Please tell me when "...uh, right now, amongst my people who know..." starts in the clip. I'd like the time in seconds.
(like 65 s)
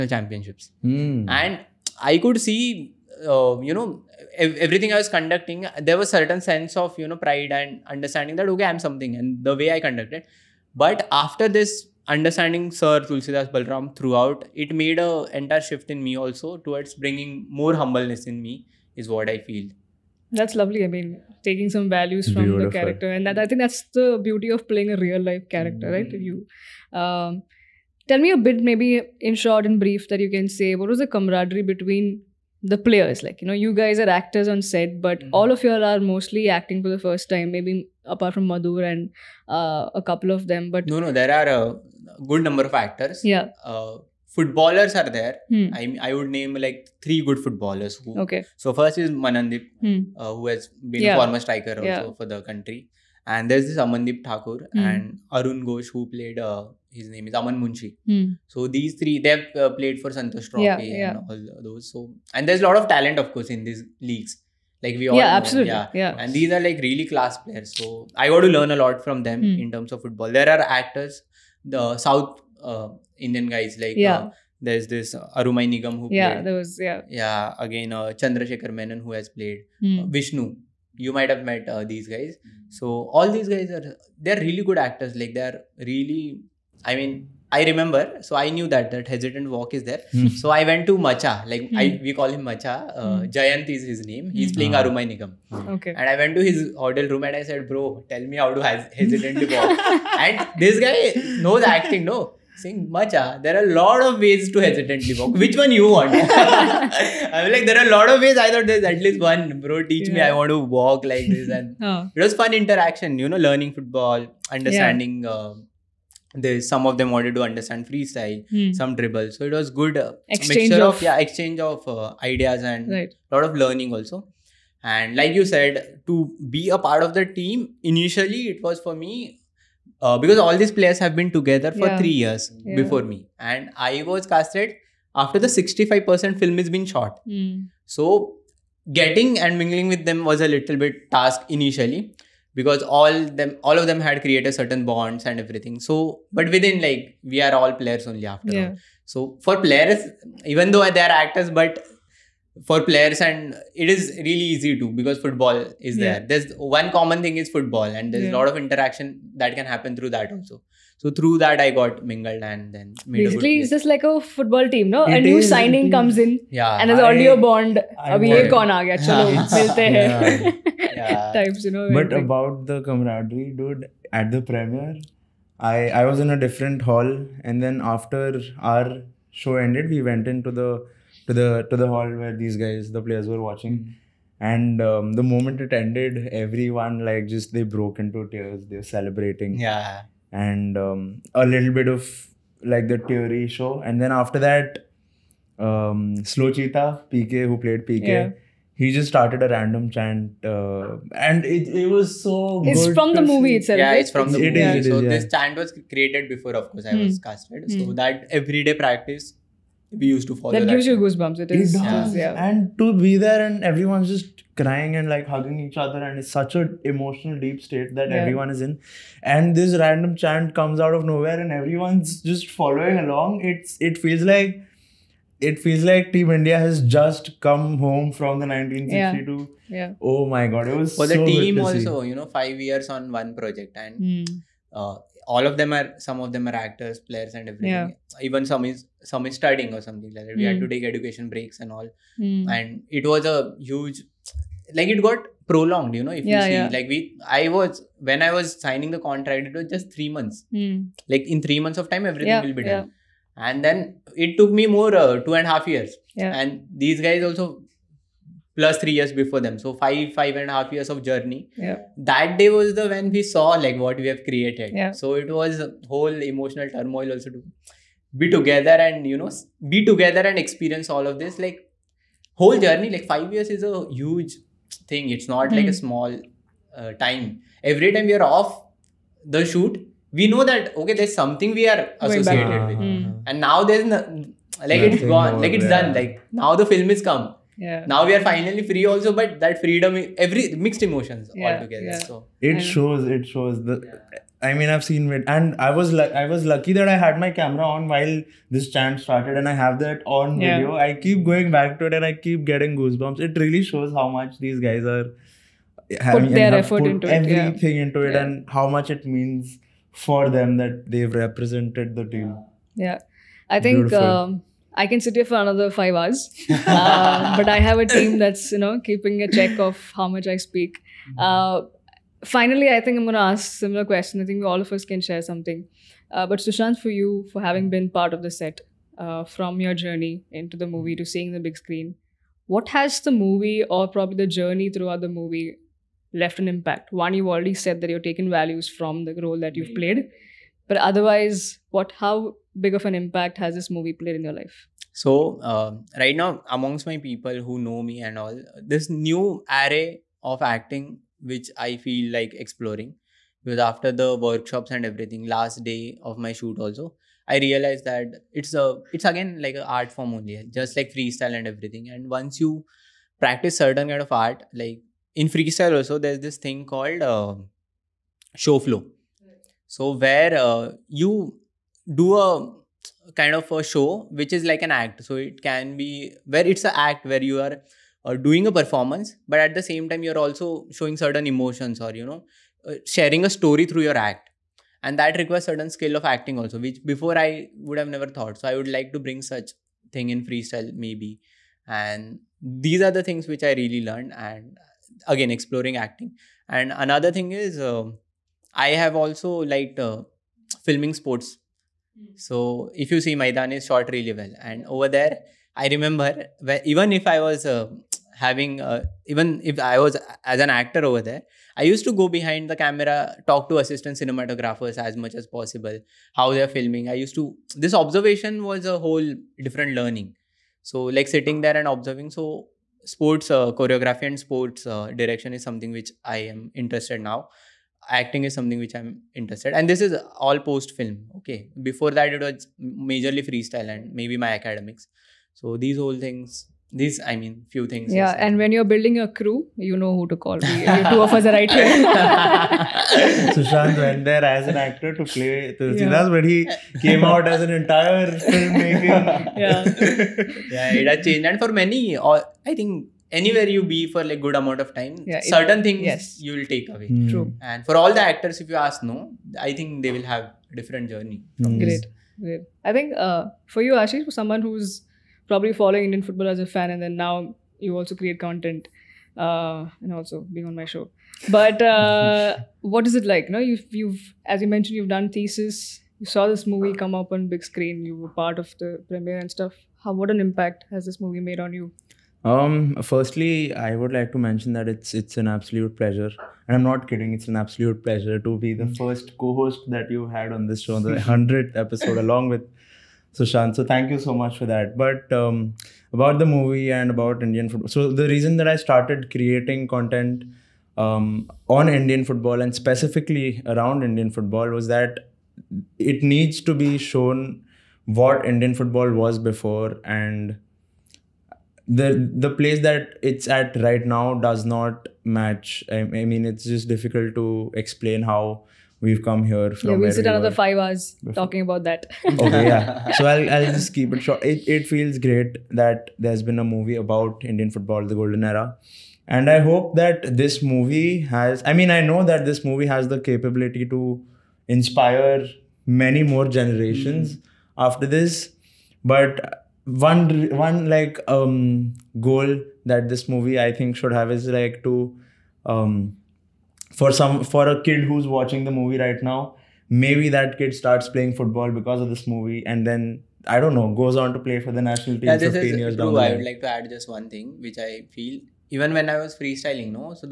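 345 s.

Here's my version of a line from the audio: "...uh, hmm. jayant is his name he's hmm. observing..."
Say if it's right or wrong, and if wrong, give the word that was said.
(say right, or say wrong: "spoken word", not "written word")
wrong: "playing", not "observing".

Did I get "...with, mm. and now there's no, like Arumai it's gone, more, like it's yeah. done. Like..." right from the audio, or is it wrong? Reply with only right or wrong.
wrong.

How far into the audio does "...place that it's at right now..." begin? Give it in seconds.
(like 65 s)
512 s.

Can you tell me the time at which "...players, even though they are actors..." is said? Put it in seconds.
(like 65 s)
149 s.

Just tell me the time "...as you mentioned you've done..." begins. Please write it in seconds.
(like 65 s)
474 s.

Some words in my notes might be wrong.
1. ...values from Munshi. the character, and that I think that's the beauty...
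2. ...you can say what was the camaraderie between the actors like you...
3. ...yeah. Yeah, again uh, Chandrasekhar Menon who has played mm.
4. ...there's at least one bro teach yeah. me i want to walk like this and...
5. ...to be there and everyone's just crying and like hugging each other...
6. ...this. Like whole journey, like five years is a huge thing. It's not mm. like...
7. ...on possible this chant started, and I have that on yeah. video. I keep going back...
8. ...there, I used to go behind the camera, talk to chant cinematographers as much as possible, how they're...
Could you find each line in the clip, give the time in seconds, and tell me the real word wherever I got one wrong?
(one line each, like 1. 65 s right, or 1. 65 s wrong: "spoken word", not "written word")
1. 21 s wrong: "Beautiful", not "Munshi"
2. 30 s wrong: "players", not "actors"
3. 76 s right
4. 108 s right
5. 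212 s right
6. 271 s right
7. 297 s wrong: "while", not "possible"
8. 411 s wrong: "assistant", not "chant".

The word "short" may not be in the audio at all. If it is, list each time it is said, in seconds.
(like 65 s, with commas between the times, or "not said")
29 s, 403 s, 524 s.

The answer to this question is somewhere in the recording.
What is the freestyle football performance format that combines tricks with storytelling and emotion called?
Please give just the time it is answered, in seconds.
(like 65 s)
368 s.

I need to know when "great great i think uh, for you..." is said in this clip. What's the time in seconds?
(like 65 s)
461 s.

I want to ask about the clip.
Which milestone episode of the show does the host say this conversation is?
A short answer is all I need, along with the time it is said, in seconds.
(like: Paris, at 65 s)
Hundredth, at 491 s.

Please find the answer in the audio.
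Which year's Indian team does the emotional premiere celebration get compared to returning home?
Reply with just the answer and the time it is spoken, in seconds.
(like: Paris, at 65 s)
1962, at 228 s.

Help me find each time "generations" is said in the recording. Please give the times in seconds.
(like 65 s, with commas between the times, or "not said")
536 s.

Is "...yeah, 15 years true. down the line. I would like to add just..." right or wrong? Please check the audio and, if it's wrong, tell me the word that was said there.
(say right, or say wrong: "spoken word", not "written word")
right.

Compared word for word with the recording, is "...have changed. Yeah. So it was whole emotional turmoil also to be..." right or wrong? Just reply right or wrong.
wrong.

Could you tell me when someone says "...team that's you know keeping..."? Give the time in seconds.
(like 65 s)
317 s.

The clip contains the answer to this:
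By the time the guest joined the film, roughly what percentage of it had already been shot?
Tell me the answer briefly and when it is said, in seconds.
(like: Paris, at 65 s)
65%, at 135 s.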